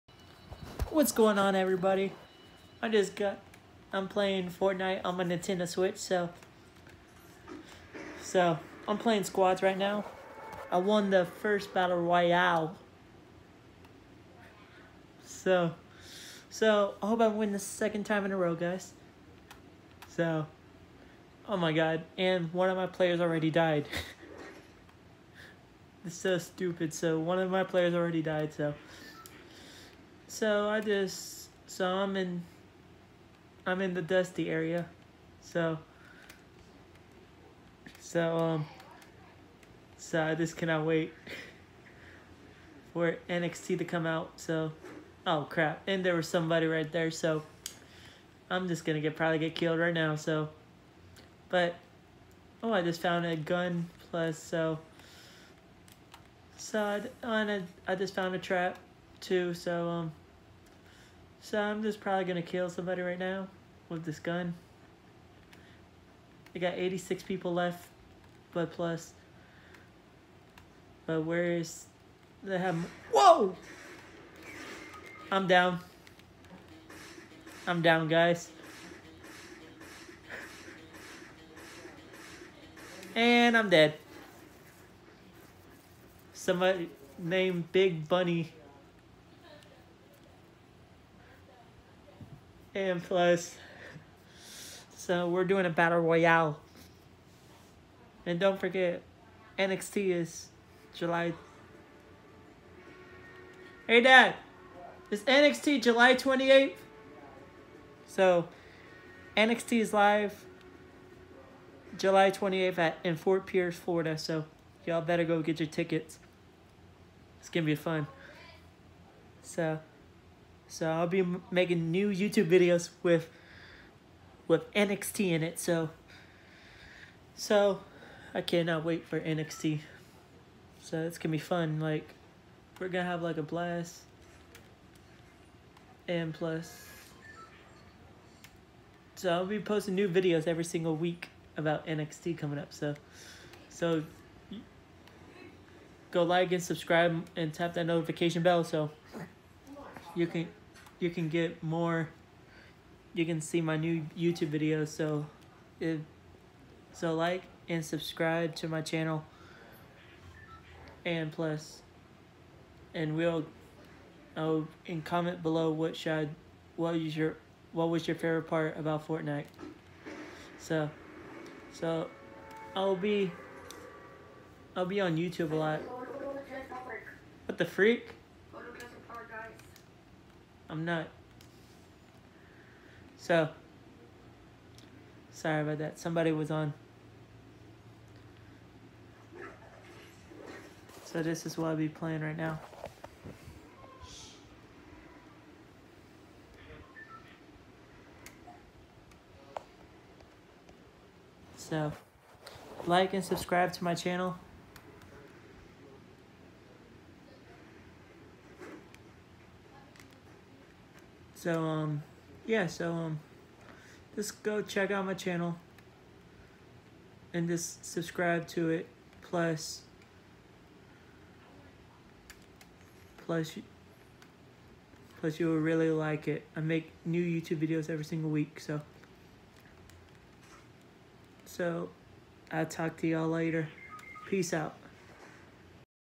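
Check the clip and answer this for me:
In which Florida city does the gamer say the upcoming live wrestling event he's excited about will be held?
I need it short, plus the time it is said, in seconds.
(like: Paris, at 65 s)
Fort Pierce, at 113 s.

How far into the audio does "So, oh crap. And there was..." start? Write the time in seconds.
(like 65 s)
44 s.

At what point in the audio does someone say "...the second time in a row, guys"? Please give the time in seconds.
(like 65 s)
17 s.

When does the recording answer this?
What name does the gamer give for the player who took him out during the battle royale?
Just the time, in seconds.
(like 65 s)
87 s.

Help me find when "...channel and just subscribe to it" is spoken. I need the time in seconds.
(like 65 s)
215 s.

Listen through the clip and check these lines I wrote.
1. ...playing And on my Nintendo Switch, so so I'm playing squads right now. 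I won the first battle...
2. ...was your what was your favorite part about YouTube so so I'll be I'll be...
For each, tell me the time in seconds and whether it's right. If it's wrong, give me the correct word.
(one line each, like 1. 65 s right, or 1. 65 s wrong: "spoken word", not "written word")
1. 4 s wrong: "Fortnite", not "And"
2. 166 s wrong: "Fortnite", not "YouTube".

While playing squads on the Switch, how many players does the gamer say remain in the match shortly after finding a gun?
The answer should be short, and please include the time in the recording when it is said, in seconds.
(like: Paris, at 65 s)
86, at 66 s.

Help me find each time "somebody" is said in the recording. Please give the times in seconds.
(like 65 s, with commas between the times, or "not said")
46 s, 62 s, 86 s, 185 s.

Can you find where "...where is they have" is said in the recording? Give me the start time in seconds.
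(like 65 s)
71 s.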